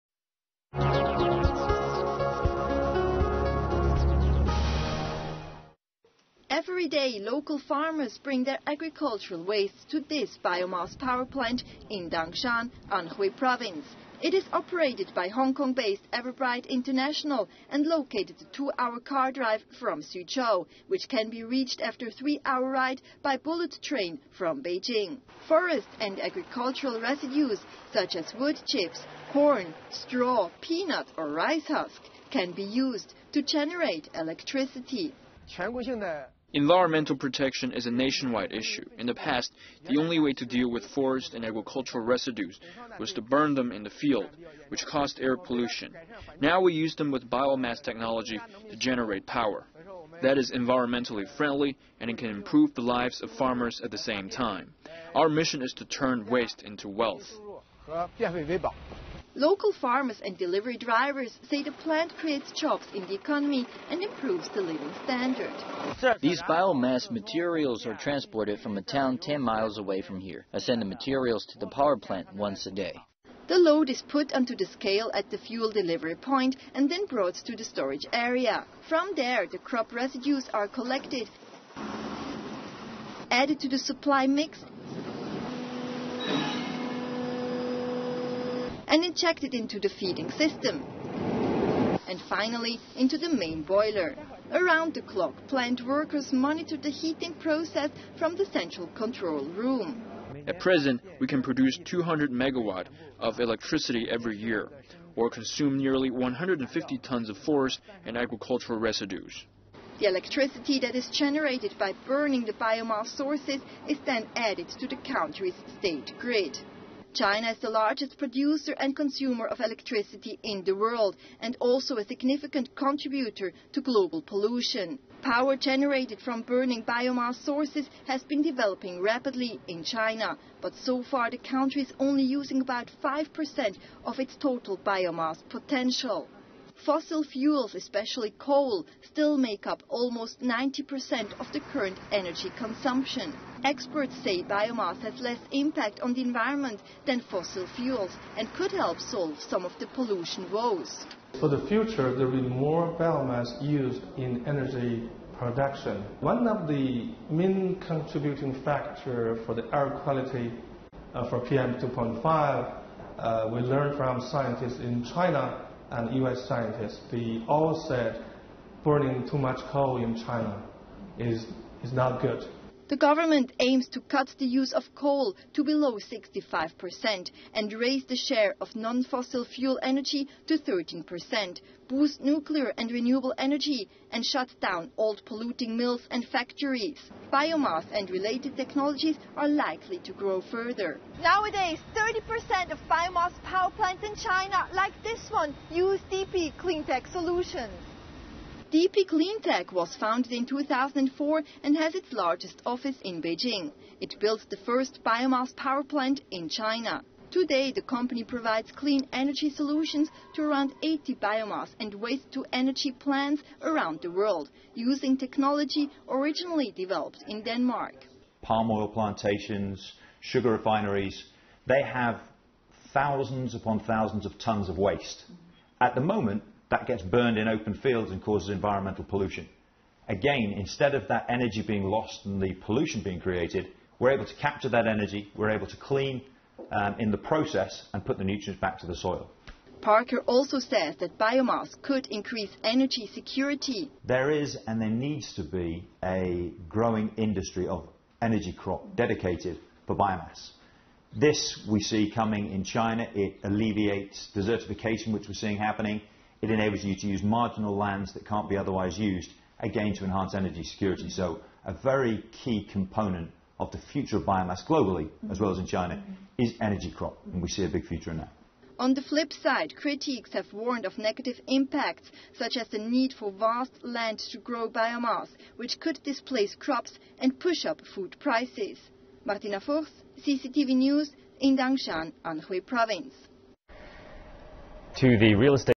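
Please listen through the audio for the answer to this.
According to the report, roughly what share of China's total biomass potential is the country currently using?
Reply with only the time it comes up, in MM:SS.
02:13.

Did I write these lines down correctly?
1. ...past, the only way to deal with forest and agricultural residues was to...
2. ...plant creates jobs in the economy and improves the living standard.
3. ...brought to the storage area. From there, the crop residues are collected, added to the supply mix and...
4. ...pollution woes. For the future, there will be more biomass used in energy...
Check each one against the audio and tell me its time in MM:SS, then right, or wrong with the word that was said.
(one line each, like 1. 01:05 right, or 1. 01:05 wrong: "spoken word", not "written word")
1. 00:39 right
2. 01:01 right
3. 01:17 right
4. 02:29 right.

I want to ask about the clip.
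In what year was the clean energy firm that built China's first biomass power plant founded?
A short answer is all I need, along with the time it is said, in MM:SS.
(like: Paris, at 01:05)
2004, at 03:20.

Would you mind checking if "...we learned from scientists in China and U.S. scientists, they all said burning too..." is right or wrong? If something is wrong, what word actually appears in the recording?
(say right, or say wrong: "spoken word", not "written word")
right.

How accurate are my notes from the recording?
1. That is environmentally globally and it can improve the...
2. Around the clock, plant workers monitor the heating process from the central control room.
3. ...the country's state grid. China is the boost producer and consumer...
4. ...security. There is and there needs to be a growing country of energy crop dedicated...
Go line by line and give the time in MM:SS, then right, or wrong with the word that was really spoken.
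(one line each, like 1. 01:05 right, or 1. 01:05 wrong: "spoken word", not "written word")
1. 00:50 wrong: "friendly", not "globally"
2. 01:34 right
3. 01:54 wrong: "largest", not "boost"
4. 04:03 wrong: "industry", not "country".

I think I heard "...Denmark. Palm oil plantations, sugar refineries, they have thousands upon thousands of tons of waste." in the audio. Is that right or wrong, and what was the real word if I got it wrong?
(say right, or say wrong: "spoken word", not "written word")
right.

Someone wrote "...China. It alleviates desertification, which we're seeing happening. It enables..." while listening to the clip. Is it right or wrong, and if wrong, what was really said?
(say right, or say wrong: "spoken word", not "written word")
right.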